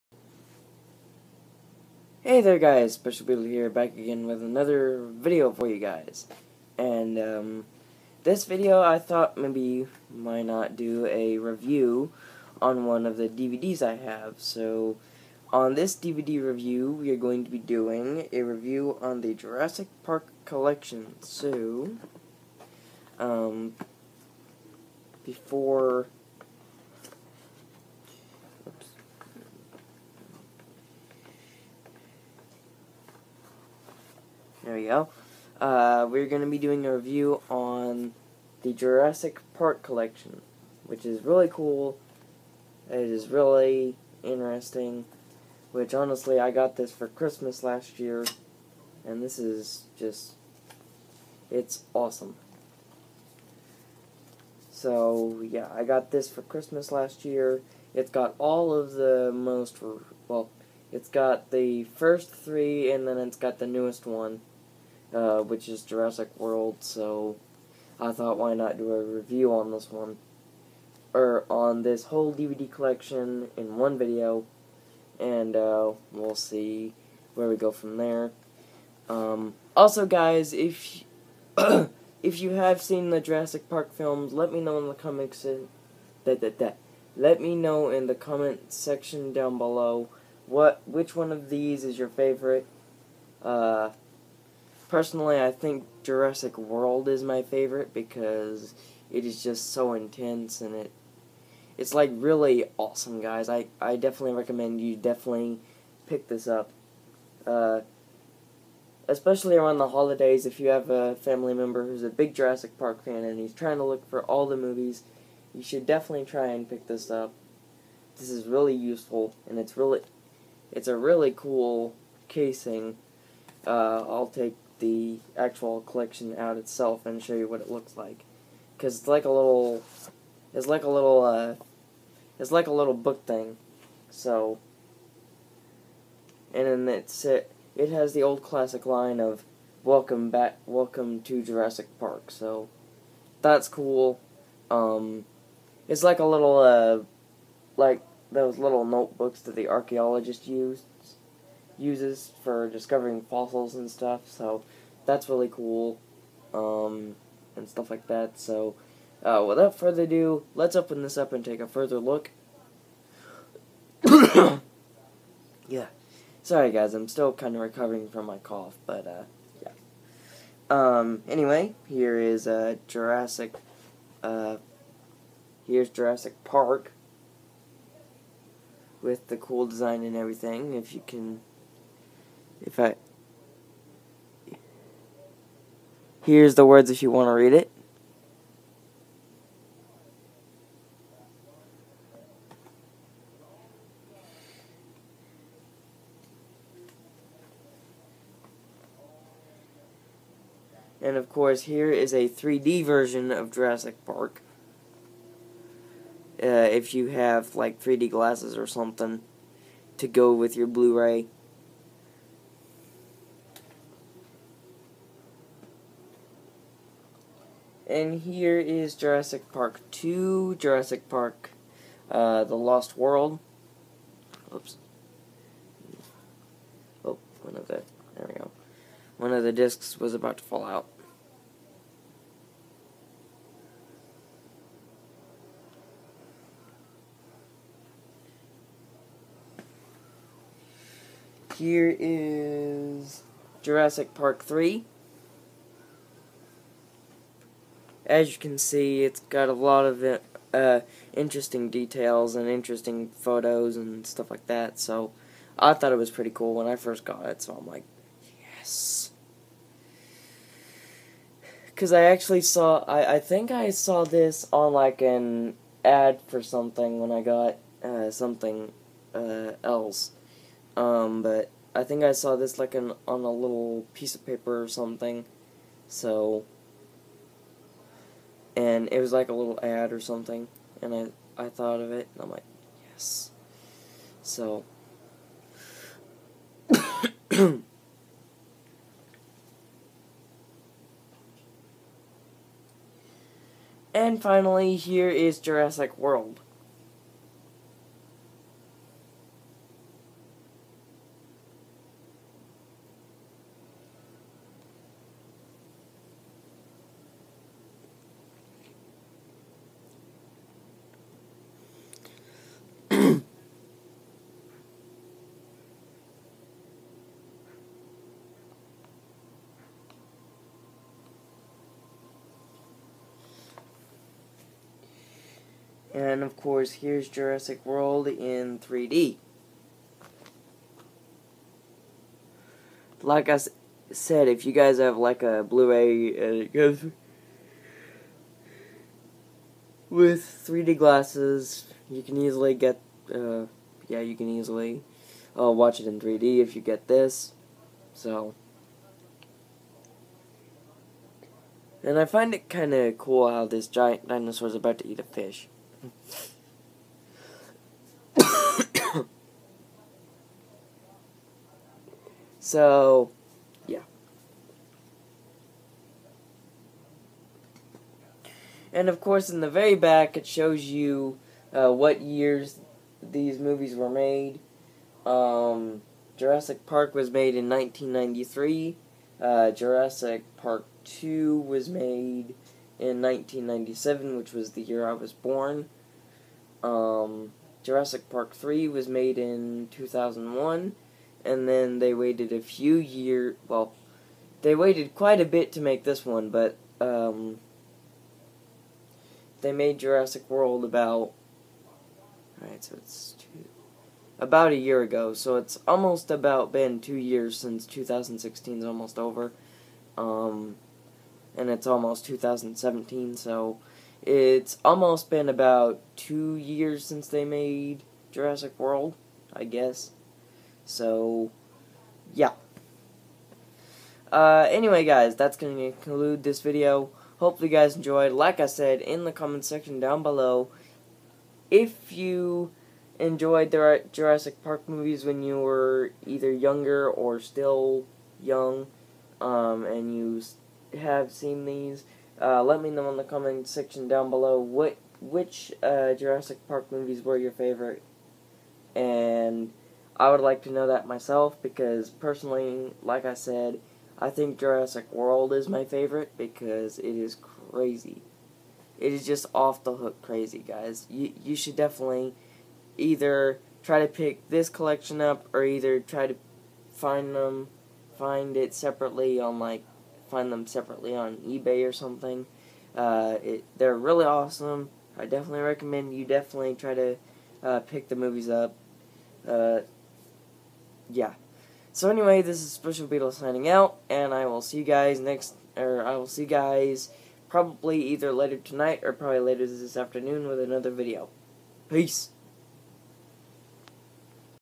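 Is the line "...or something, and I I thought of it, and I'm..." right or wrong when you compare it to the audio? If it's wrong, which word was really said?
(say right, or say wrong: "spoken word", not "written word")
right.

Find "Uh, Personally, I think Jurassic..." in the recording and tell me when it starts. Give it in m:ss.
1:33.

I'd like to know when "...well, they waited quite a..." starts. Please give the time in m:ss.
6:33.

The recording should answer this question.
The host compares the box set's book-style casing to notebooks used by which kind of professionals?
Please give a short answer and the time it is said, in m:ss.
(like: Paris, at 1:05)
archaeologists, at 2:29.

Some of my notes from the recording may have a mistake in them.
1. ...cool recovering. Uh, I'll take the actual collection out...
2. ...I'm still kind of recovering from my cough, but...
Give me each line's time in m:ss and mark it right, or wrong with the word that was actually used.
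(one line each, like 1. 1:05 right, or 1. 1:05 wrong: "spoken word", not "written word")
1. 2:01 wrong: "casing", not "recovering"
2. 2:46 right.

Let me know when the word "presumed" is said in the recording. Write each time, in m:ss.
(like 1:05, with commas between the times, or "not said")
not said.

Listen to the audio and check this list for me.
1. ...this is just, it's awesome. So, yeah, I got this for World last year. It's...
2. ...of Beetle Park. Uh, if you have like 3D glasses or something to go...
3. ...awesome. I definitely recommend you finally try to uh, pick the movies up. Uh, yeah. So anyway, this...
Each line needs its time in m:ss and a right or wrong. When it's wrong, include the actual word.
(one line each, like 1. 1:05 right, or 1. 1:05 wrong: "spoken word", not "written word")
1. 0:49 wrong: "Christmas", not "World"
2. 3:23 wrong: "Jurassic", not "Beetle"
3. 7:54 wrong: "definitely", not "finally".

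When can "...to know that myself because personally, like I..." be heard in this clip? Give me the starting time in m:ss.
7:30.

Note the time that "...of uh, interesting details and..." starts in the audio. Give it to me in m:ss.
4:09.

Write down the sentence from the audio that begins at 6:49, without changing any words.
Um, and it's almost 2017, so it's almost been about two years since they made Jurassic World, I guess.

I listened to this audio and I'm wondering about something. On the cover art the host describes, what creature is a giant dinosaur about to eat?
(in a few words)
a fish.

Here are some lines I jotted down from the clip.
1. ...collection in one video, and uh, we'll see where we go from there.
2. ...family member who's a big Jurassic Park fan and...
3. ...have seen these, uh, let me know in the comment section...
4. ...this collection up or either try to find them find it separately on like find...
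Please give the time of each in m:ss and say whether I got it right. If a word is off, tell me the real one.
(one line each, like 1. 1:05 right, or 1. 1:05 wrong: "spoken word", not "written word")
1. 1:12 right
2. 1:51 right
3. 7:20 right
4. 7:44 right.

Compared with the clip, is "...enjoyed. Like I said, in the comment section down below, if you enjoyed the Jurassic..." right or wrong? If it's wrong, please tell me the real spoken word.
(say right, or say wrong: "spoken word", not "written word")
right.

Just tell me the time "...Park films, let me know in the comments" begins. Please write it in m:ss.
1:23.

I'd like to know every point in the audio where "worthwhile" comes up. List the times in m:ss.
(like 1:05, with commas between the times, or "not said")
not said.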